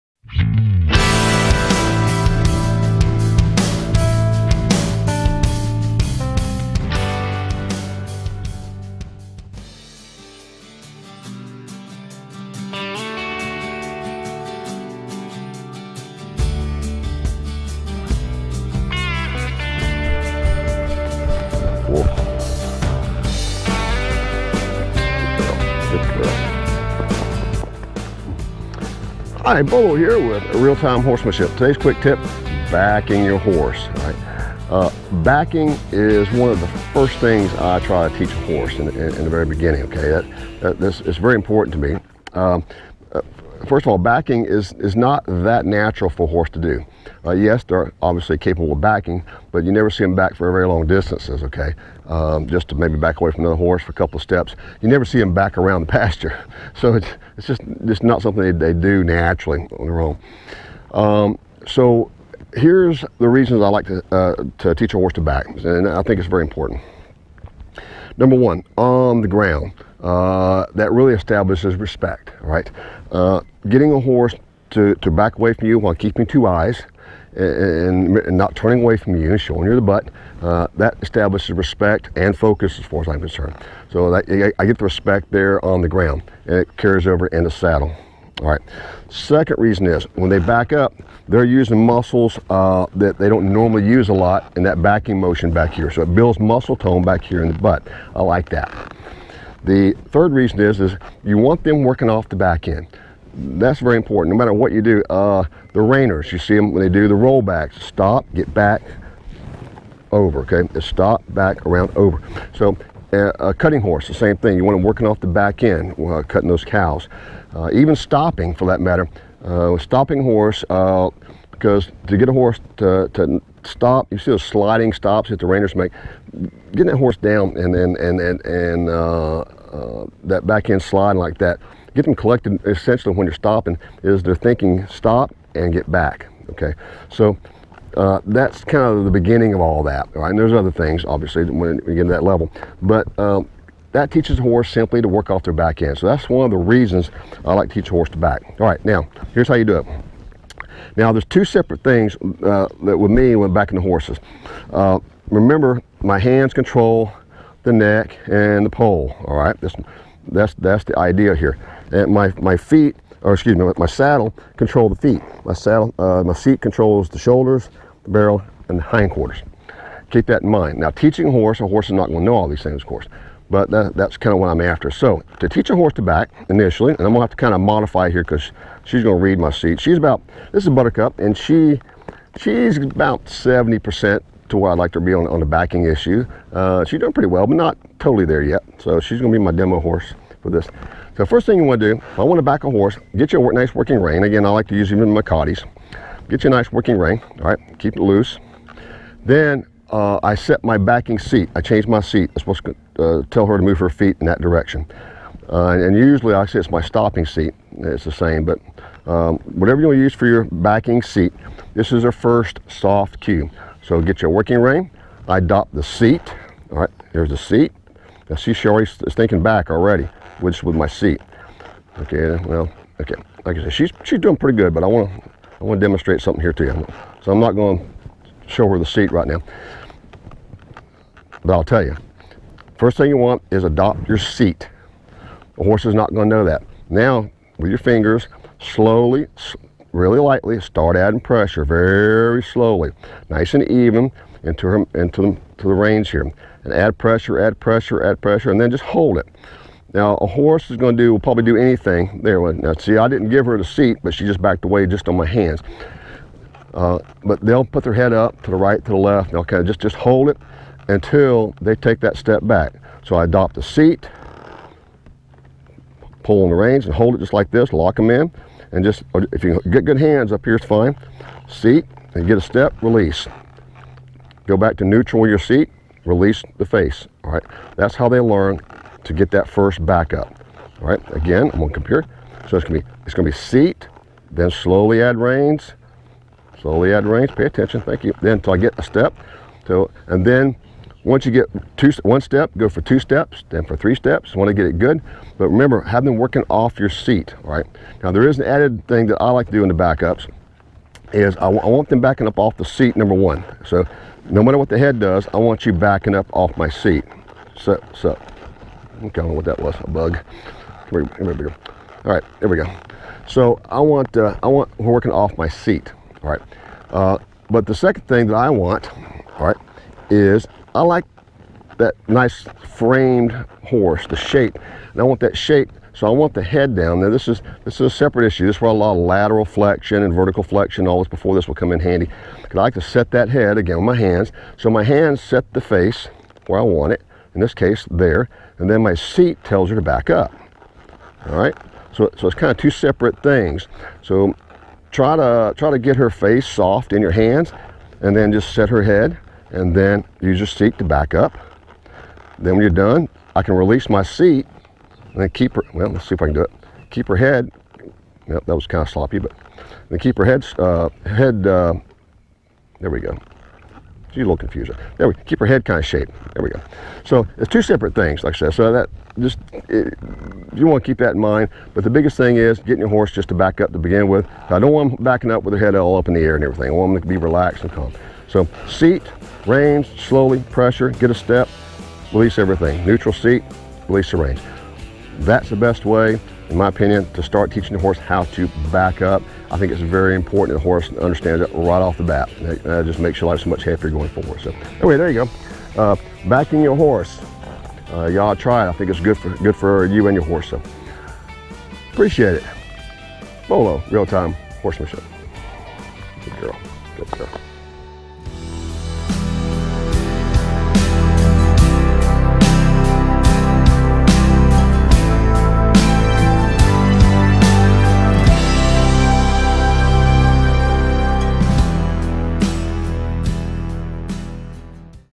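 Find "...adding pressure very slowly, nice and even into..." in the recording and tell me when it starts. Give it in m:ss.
4:00.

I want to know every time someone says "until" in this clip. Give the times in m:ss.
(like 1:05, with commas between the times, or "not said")
4:20, 4:48.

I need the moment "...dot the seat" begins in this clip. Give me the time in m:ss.
3:35.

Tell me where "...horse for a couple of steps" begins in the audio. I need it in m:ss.
0:53.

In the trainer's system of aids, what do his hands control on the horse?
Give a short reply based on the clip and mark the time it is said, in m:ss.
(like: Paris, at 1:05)
The neck and the poll, at 2:37.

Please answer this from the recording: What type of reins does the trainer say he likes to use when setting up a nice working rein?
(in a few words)
Cotties.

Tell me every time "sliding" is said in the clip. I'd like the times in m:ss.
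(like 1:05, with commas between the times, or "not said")
2:04, 2:10.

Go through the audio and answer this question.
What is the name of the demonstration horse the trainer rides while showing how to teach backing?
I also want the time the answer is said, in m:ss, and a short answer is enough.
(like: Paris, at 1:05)
Buttercup, at 3:00.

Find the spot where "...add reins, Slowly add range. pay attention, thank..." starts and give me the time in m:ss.
4:45.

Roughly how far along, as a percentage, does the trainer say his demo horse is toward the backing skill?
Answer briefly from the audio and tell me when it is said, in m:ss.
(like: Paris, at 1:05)
70%, at 3:03.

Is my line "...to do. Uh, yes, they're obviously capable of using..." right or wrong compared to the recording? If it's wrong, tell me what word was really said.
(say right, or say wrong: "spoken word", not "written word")
wrong: "backing", not "using".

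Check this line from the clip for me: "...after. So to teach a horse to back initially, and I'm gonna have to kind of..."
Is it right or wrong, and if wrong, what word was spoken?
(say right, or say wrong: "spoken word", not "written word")
right.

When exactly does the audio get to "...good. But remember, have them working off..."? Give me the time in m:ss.
4:54.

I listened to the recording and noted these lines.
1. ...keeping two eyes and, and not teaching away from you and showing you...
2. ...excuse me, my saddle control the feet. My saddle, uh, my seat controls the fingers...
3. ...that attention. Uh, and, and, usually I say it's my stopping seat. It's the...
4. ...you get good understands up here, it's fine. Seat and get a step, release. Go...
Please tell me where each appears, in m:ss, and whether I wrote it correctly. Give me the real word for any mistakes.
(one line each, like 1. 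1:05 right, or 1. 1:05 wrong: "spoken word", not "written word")
1. 1:15 wrong: "turning", not "teaching"
2. 2:43 wrong: "shoulders", not "fingers"
3. 3:24 wrong: "direction", not "attention"
4. 4:29 wrong: "hands", not "understands".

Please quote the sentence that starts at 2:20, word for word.
And there's other things, obviously, when you get to that level.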